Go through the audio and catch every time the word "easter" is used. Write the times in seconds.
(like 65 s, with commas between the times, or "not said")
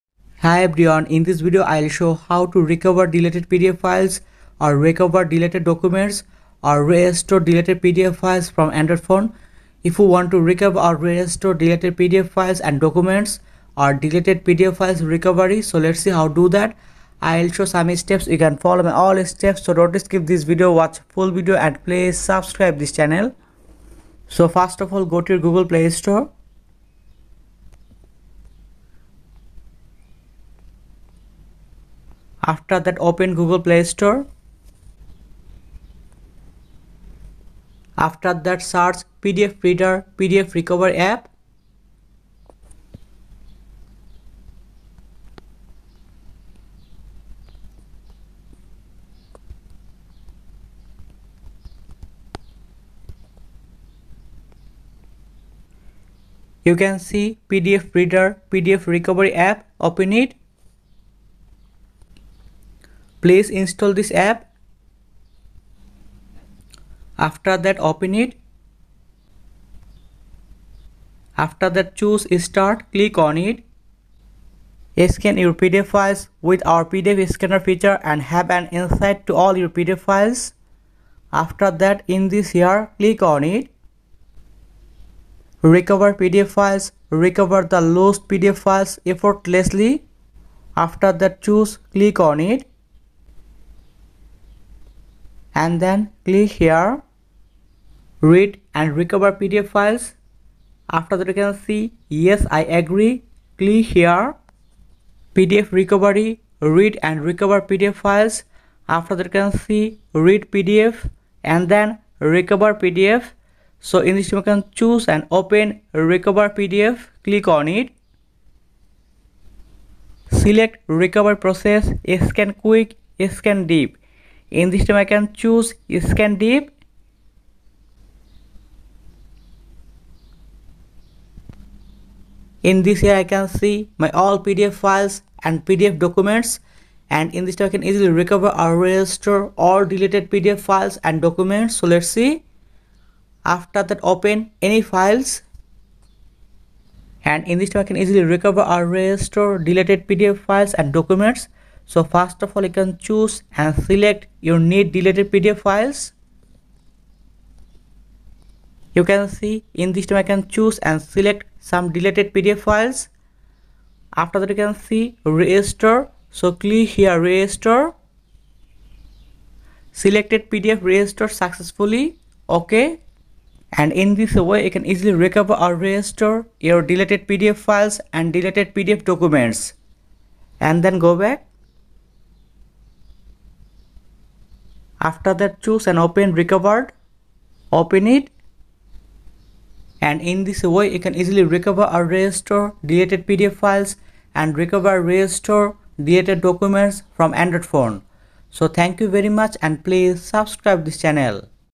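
not said.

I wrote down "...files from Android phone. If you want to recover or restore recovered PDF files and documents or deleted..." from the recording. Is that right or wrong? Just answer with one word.
wrong.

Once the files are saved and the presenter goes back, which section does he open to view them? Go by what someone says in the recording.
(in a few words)
recovered.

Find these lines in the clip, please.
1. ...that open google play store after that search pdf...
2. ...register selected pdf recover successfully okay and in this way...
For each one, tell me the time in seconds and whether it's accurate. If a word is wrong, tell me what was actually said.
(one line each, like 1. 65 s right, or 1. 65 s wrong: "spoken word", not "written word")
1. 32 s right
2. 167 s wrong: "register", not "recover".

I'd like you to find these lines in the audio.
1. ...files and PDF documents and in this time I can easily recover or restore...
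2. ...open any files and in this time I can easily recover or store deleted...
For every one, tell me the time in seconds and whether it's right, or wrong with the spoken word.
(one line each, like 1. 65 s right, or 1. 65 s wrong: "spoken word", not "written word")
1. 134 s right
2. 144 s wrong: "restore", not "store".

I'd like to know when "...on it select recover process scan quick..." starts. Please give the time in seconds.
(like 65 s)
117 s.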